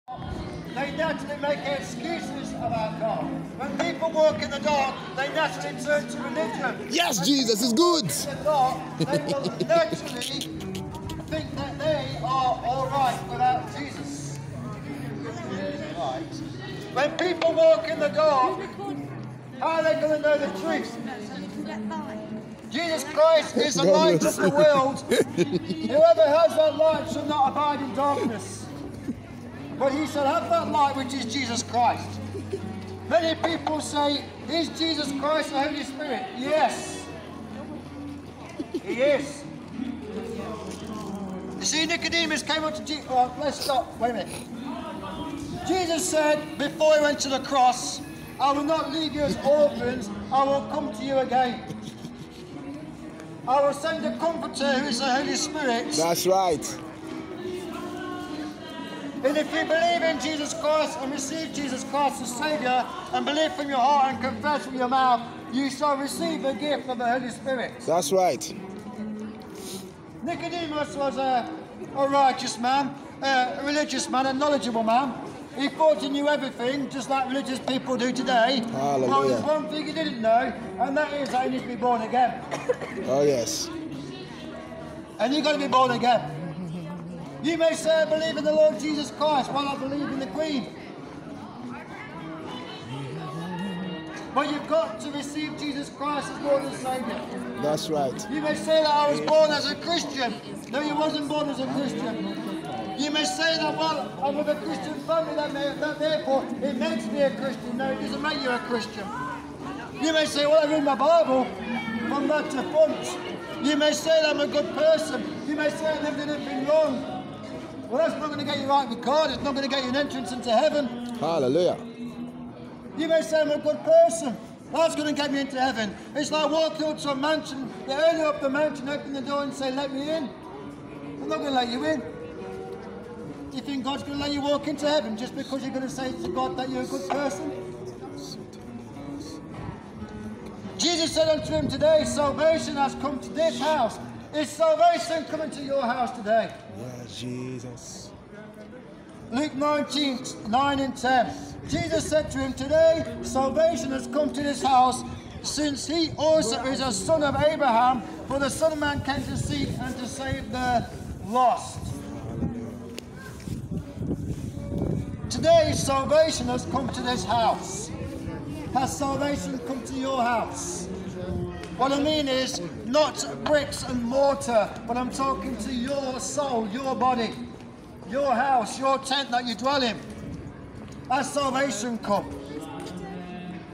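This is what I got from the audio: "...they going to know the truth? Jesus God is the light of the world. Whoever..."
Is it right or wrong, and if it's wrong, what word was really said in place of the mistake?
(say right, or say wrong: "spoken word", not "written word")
wrong: "Christ", not "God".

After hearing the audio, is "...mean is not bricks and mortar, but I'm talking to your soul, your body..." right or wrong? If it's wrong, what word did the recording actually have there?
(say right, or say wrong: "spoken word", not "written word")
right.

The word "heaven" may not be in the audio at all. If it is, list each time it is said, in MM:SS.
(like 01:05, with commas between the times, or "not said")
02:00, 02:05, 02:14.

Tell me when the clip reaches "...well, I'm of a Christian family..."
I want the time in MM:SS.
01:43.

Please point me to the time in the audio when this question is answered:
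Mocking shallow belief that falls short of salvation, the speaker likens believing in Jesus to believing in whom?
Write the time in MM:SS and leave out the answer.
01:30.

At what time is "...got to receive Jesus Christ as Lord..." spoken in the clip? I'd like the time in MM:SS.
01:34.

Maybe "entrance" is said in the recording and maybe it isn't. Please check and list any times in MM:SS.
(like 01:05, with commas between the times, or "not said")
01:59.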